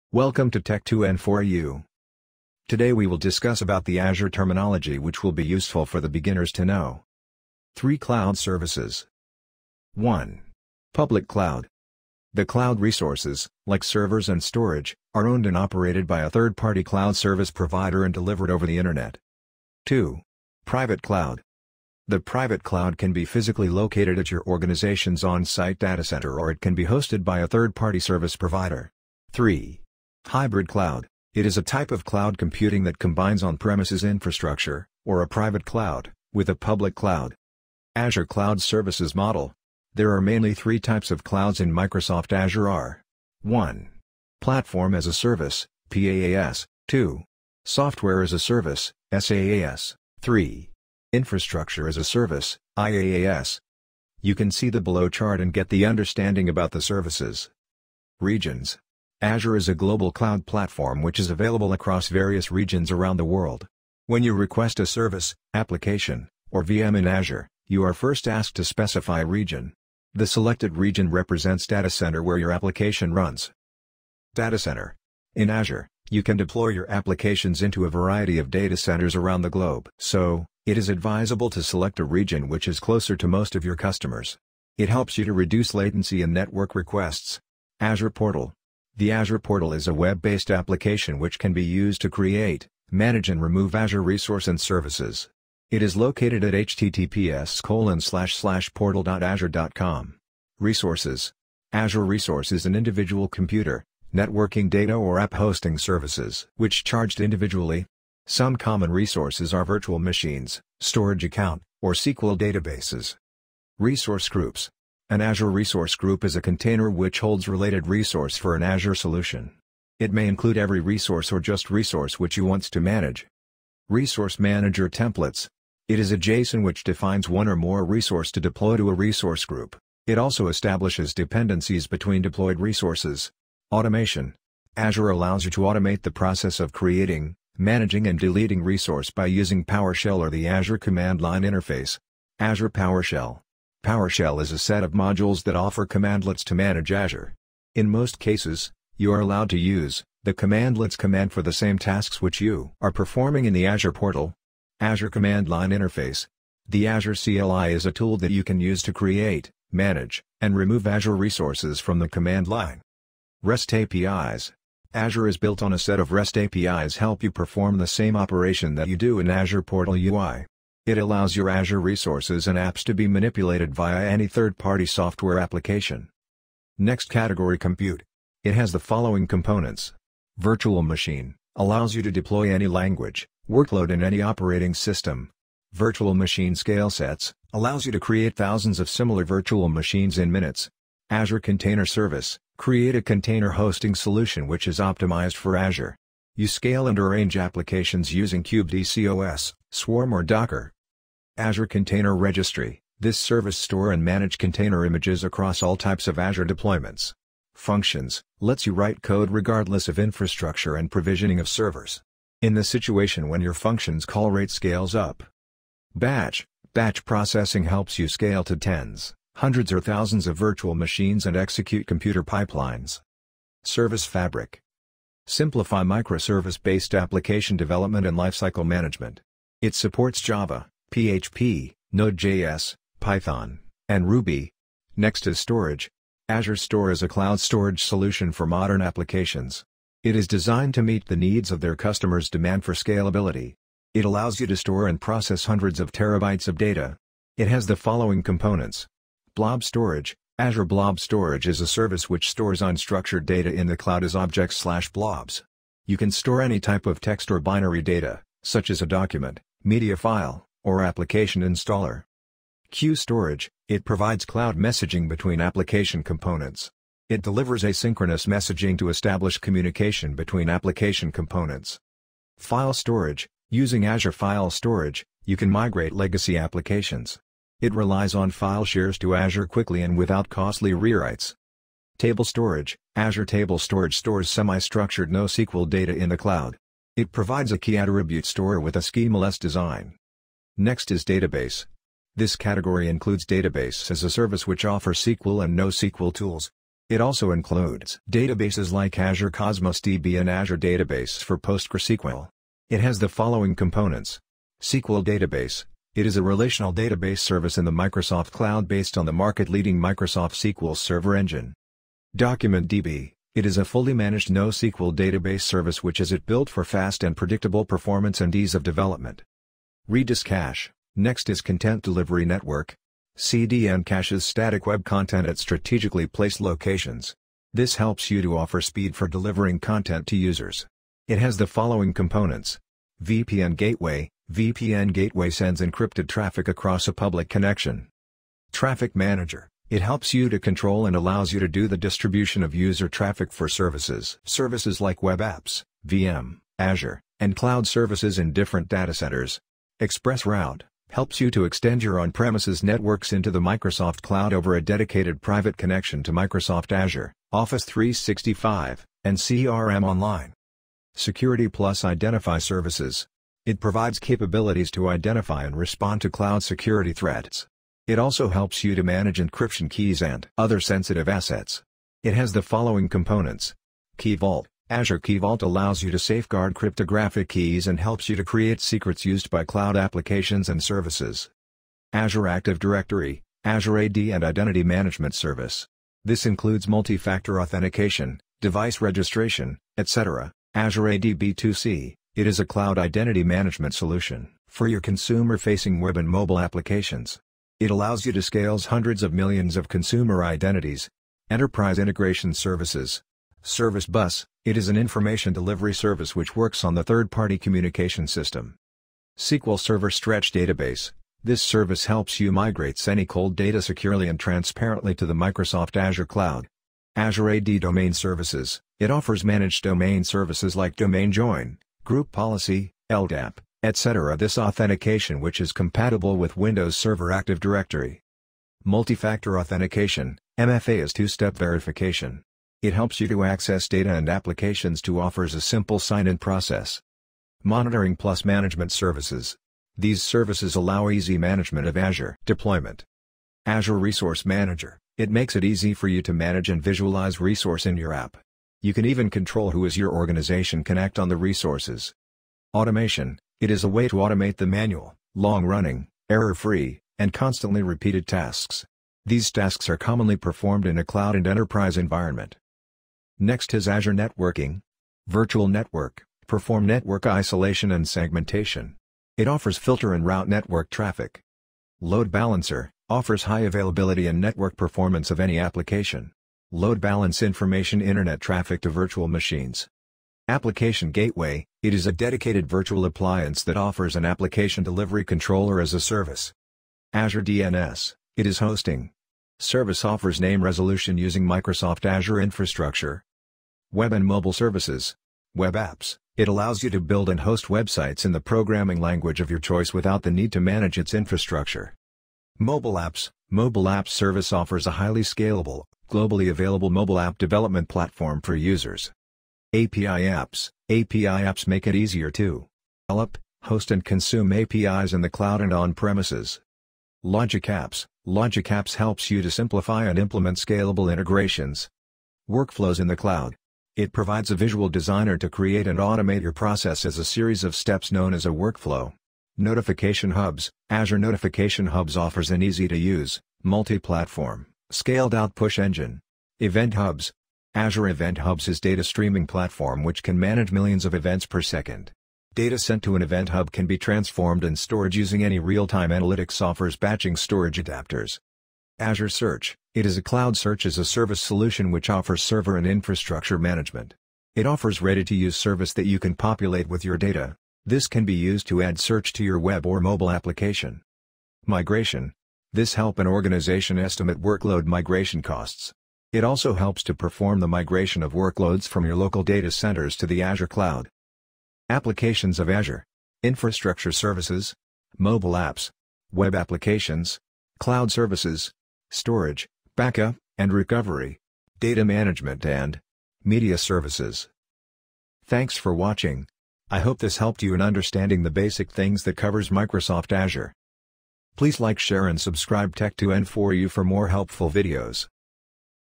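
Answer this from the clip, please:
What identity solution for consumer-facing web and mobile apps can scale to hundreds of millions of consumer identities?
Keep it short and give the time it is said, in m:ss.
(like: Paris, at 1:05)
Azure AD B2C, at 6:30.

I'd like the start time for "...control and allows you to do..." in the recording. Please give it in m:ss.
5:40.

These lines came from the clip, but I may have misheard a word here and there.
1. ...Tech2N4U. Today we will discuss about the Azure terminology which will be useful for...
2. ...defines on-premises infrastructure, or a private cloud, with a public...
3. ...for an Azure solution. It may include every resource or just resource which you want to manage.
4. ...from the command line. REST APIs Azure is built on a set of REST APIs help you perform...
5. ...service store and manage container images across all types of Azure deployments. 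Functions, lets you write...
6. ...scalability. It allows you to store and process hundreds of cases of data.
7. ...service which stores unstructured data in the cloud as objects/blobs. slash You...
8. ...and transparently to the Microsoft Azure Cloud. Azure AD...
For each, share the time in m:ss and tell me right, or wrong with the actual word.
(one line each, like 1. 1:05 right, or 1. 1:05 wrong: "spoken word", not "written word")
1. 0:00 right
2. 0:32 wrong: "combines", not "defines"
3. 1:58 right
4. 2:41 right
5. 3:23 right
6. 4:02 wrong: "terabytes", not "cases"
7. 4:11 right
8. 6:54 right.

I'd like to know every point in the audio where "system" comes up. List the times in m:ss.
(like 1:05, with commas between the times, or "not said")
3:04, 6:48.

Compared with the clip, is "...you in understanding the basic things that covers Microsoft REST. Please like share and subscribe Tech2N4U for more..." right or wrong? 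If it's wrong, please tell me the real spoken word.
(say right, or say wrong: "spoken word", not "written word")
wrong: "Azure", not "REST".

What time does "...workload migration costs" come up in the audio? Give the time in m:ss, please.
9:24.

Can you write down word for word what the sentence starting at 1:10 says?
The selected region represents data center where your application runs.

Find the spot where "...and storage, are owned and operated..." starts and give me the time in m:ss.
0:14.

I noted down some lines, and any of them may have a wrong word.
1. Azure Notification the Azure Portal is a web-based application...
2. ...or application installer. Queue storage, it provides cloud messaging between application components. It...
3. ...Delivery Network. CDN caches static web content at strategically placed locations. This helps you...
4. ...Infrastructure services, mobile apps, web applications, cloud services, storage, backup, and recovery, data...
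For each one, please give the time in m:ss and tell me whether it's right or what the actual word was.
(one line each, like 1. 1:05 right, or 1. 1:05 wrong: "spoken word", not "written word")
1. 1:27 wrong: "Portal", not "Notification"
2. 4:20 right
3. 5:21 right
4. 9:33 right.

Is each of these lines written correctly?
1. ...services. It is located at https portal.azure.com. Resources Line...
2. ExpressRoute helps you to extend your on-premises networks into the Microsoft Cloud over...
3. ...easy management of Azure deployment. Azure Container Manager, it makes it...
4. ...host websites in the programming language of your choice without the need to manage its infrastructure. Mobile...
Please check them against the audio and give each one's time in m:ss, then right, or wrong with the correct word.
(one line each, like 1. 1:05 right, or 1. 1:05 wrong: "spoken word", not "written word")
1. 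1:34 wrong: "Azure", not "Line"
2. 5:49 right
3. 7:20 wrong: "Resource", not "Container"
4. 8:17 right.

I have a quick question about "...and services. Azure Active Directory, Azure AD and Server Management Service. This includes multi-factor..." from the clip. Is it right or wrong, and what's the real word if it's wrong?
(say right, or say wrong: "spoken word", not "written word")
wrong: "Identity", not "Server".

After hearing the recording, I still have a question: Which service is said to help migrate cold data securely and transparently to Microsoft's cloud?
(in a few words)
SQL Server Stretch Database.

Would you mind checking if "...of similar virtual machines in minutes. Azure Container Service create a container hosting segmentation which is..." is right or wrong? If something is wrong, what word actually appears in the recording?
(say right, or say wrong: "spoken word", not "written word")
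wrong: "solution", not "segmentation".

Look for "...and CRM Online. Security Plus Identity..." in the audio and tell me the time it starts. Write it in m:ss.
5:59.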